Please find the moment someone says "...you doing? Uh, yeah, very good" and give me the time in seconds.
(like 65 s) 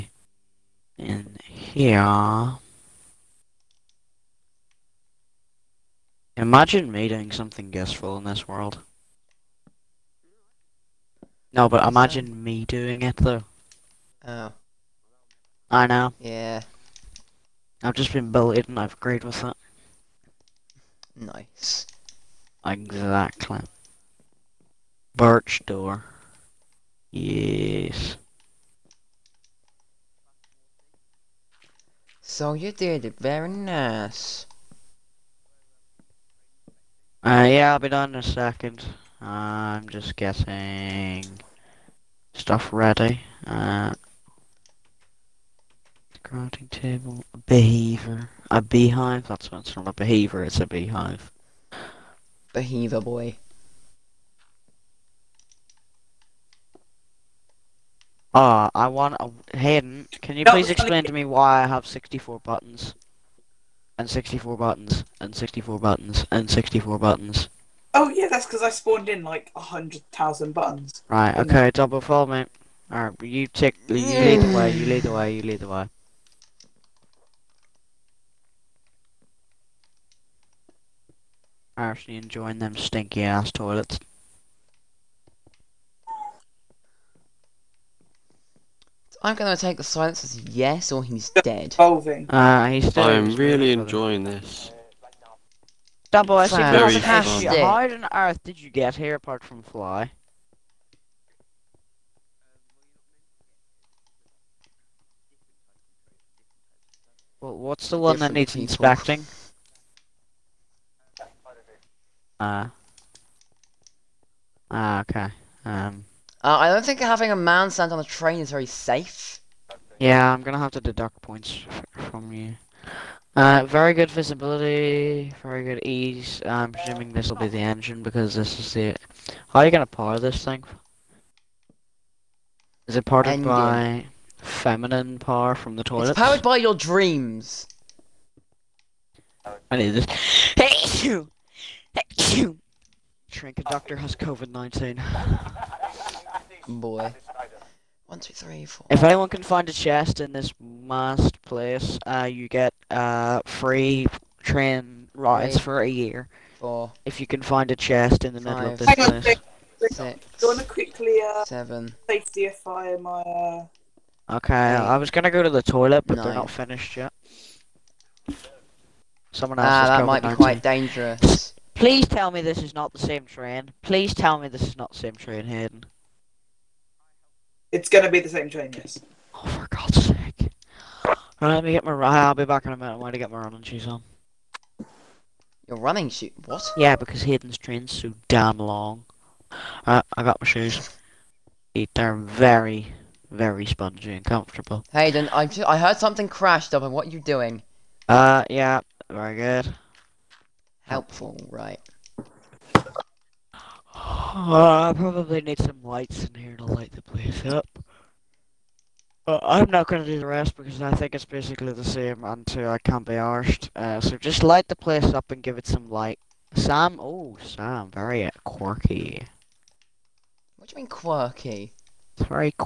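197 s.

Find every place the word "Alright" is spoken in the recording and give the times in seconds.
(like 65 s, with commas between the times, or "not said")
72 s, 181 s, 189 s.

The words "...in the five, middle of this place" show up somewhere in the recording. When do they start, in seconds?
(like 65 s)
158 s.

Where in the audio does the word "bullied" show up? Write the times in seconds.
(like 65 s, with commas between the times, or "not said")
18 s.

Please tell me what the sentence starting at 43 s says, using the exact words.
Uh, crafting table, a behavior, a beehive.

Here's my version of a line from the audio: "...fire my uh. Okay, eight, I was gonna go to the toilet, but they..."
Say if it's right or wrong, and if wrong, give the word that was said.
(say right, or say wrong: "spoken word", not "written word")
right.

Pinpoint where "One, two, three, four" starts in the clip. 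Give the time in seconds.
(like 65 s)
148 s.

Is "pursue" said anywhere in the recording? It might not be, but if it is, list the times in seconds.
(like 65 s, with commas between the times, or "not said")
not said.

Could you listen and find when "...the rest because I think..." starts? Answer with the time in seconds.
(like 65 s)
210 s.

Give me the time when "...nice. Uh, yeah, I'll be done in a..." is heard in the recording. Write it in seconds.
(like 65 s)
33 s.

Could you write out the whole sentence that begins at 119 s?
Yeah, I'm gonna have to deduct points from you.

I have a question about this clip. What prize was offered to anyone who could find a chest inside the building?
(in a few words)
Free train rides for a year.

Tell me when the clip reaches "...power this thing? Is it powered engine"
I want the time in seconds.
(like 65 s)
129 s.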